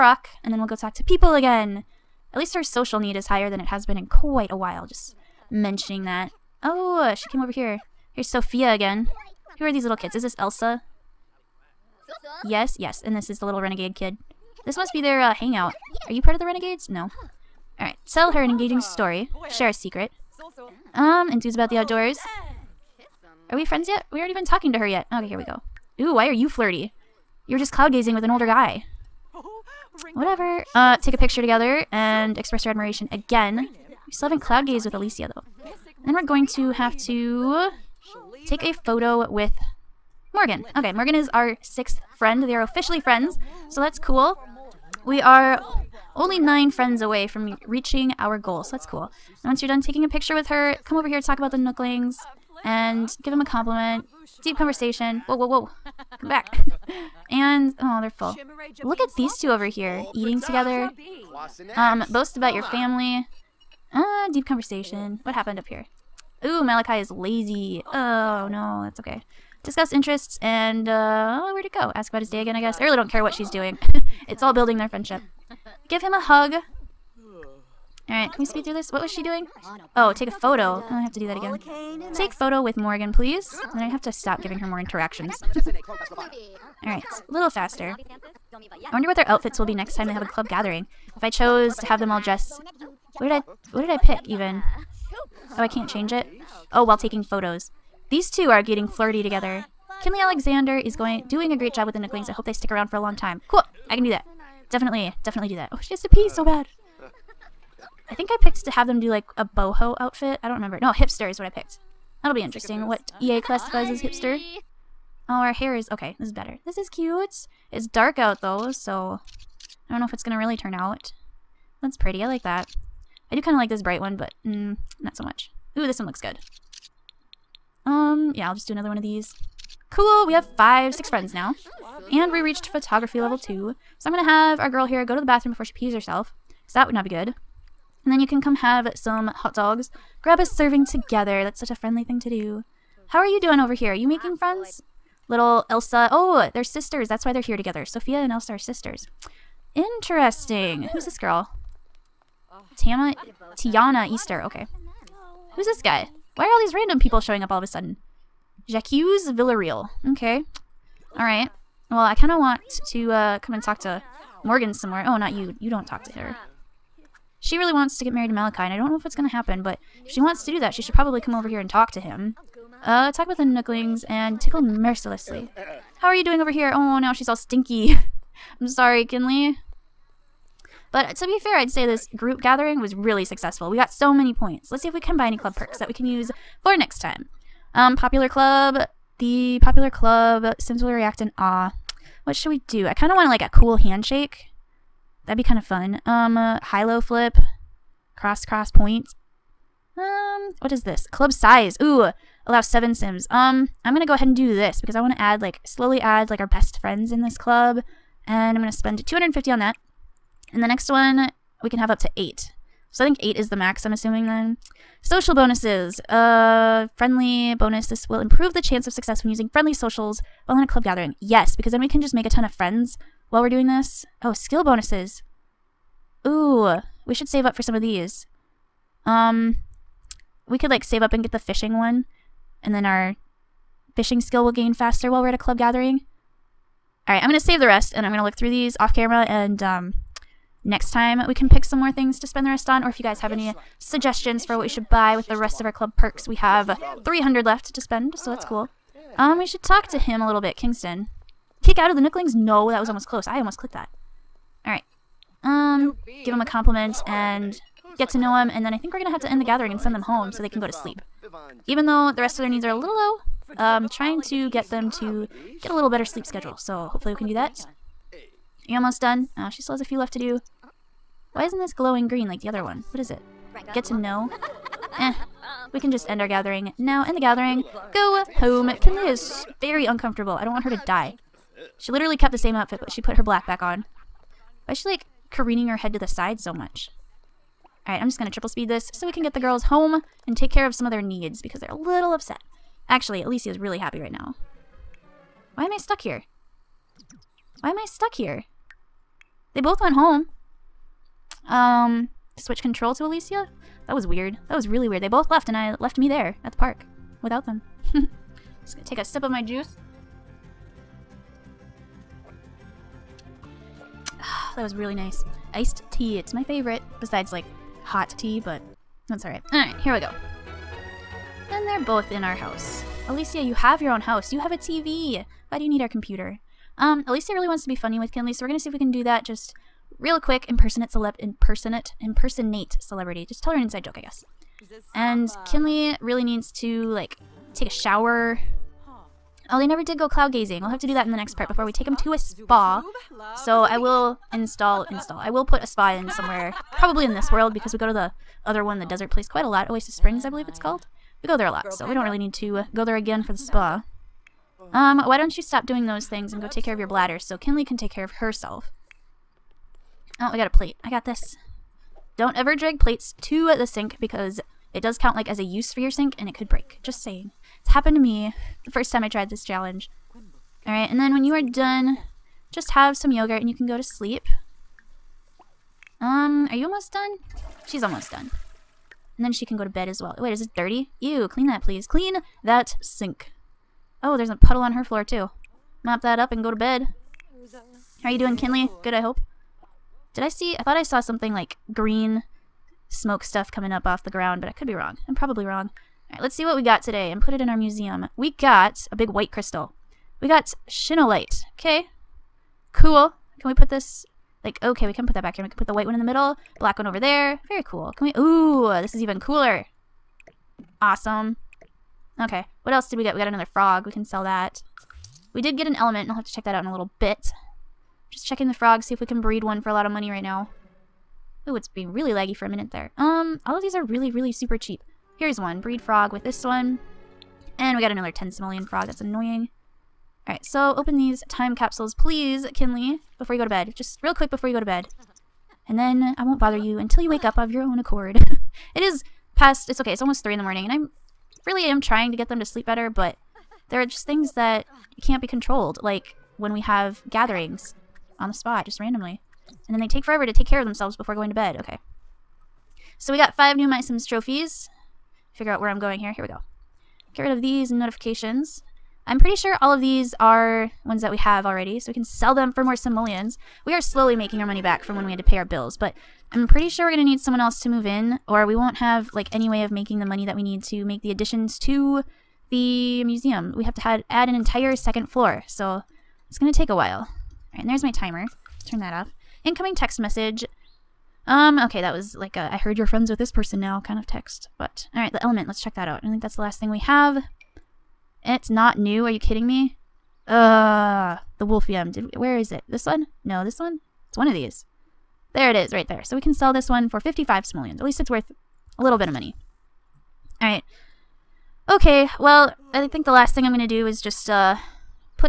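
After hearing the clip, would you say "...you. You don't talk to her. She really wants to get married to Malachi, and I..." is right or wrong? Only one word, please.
right.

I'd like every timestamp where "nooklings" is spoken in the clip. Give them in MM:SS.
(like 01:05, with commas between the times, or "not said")
00:51, 01:41, 02:53, 04:11.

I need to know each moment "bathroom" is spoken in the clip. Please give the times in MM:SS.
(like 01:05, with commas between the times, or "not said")
02:15.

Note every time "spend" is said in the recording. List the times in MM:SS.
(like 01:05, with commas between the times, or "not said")
03:28, 04:02, 04:07.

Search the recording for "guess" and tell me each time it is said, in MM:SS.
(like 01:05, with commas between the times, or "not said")
01:12, 05:33.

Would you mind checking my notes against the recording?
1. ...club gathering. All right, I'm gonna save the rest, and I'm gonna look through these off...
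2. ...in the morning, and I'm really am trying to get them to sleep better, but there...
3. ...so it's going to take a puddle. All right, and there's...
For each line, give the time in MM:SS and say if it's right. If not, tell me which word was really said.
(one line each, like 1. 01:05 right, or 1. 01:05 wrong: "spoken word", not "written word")
1. 03:55 right
2. 07:20 right
3. 07:55 wrong: "while", not "puddle".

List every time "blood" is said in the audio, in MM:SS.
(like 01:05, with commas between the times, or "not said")
not said.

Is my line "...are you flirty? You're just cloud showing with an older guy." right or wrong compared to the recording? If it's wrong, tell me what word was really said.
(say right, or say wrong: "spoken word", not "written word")
wrong: "gazing", not "showing".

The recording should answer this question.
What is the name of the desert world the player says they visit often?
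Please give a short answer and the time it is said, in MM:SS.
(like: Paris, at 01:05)
Oasis Springs, at 05:49.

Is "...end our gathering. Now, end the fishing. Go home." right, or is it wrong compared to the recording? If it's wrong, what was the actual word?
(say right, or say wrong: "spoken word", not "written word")
wrong: "gathering", not "fishing".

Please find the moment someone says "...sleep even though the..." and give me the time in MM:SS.
04:20.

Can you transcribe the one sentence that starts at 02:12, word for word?
And we reached photography level two.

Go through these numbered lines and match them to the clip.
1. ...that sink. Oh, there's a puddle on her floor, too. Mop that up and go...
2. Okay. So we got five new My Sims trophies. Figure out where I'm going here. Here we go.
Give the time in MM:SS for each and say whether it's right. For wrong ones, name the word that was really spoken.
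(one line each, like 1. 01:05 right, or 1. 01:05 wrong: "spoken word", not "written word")
1. 06:22 right
2. 07:31 right.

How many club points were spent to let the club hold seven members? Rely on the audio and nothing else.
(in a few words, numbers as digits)
250.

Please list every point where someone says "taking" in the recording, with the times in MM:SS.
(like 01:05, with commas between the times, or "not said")
00:49, 01:36.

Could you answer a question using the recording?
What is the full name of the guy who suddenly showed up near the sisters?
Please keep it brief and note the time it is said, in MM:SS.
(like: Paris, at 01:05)
Jacques Villarreal, at 02:38.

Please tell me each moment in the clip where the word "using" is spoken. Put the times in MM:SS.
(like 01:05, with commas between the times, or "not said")
03:39.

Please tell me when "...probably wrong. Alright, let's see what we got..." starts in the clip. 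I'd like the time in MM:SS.
06:35.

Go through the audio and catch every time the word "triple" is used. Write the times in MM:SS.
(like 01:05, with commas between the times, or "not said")
04:48.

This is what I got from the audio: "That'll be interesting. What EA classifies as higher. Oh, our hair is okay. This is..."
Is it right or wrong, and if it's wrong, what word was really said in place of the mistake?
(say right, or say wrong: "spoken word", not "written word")
wrong: "hipster", not "higher".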